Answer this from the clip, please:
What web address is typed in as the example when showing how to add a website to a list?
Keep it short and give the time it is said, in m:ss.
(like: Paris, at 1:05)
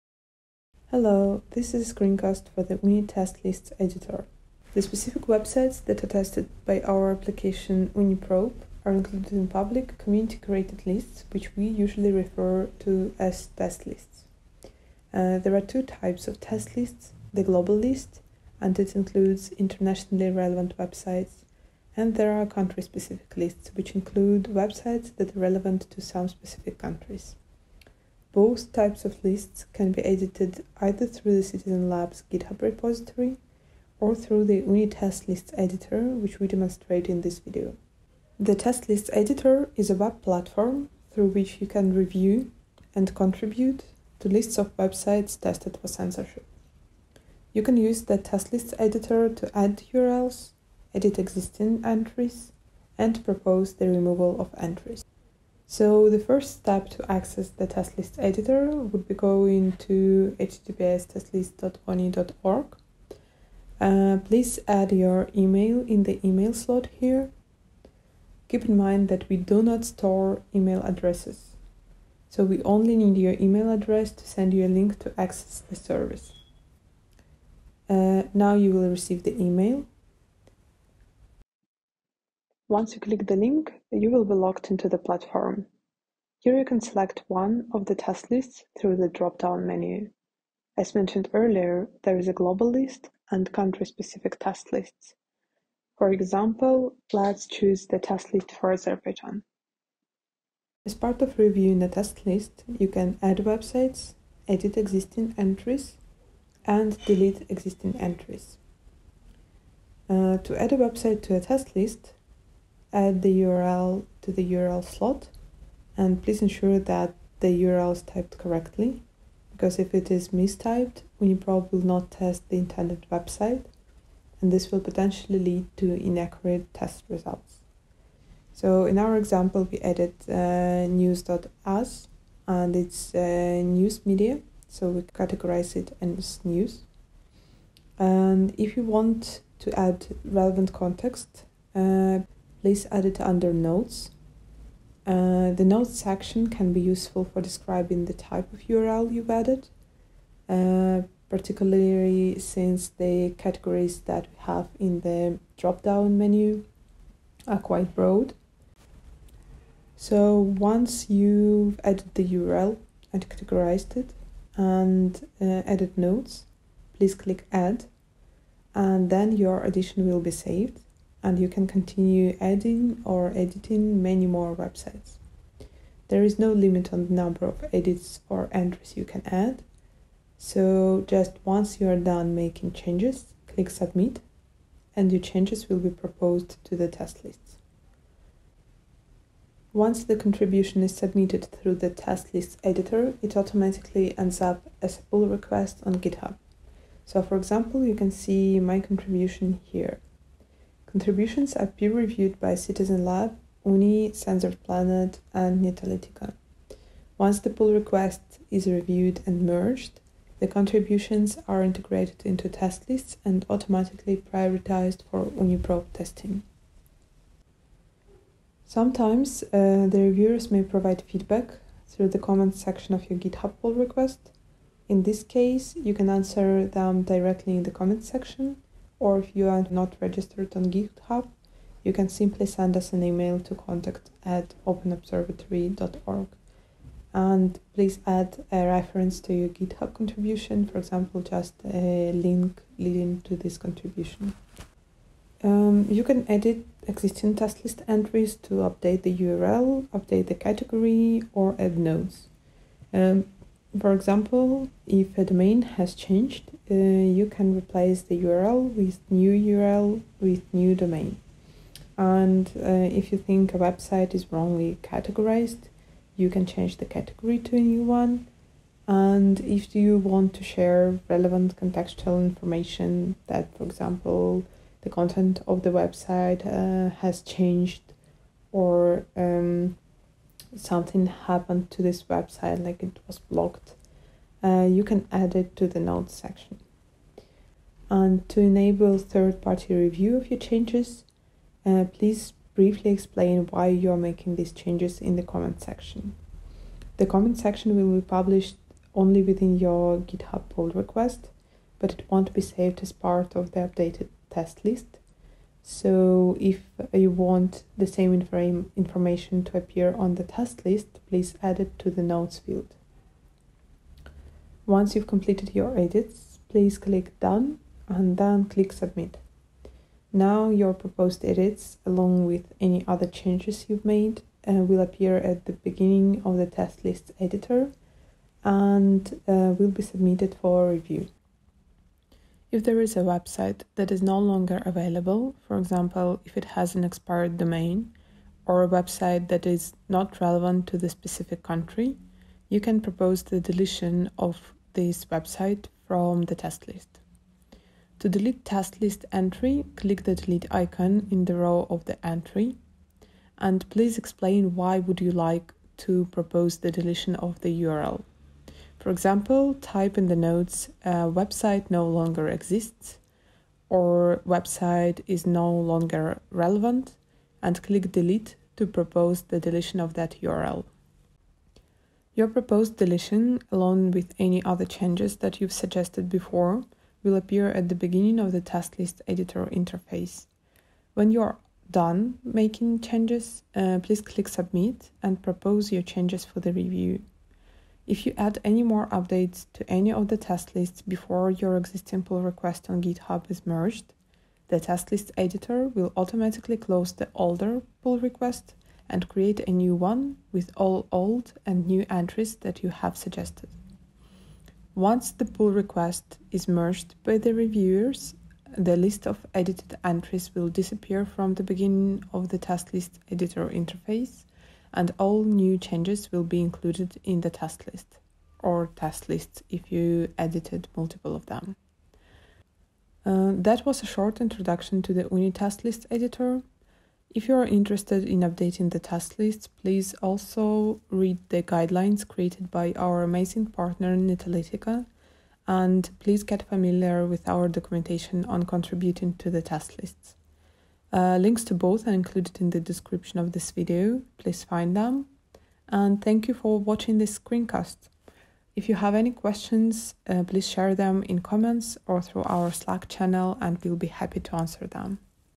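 news.us, at 2:10.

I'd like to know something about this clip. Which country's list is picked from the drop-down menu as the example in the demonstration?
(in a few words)
Azerbaijan.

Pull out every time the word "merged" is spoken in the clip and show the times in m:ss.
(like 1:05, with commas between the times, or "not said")
3:29, 6:33, 6:46.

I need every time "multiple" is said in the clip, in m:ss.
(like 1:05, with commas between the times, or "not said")
7:00.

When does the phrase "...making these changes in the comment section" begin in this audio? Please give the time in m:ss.
4:53.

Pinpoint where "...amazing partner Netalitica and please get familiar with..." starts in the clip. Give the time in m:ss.
7:13.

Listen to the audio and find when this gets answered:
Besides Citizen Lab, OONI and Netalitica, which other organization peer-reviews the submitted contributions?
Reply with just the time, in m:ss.
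3:24.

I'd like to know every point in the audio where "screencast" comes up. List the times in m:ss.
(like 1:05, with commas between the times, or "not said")
0:01, 7:27.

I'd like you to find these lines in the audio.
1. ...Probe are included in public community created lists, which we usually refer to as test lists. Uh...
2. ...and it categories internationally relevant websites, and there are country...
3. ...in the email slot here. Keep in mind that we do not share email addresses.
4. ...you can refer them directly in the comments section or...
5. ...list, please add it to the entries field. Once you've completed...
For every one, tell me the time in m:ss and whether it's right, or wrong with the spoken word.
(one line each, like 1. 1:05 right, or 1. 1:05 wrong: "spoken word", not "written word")
1. 0:08 right
2. 0:18 wrong: "includes", not "categories"
3. 1:05 wrong: "store", not "share"
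4. 3:45 wrong: "answer", not "refer"
5. 5:10 wrong: "notes", not "entries".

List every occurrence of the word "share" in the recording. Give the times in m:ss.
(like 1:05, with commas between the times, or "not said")
4:30, 7:30.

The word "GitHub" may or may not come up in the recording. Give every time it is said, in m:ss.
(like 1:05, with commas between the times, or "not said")
0:32, 3:15, 3:43, 3:50, 3:59, 4:59, 6:32.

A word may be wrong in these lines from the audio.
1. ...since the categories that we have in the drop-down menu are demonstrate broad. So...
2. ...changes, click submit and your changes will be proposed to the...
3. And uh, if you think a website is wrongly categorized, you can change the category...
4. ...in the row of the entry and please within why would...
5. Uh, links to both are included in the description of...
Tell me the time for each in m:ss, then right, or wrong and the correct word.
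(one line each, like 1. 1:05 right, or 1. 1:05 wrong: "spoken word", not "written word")
1. 2:32 wrong: "quite", not "demonstrate"
2. 3:02 right
3. 4:21 right
4. 5:51 wrong: "explain", not "within"
5. 7:20 right.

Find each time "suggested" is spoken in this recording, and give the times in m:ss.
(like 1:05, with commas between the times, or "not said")
6:15, 6:42.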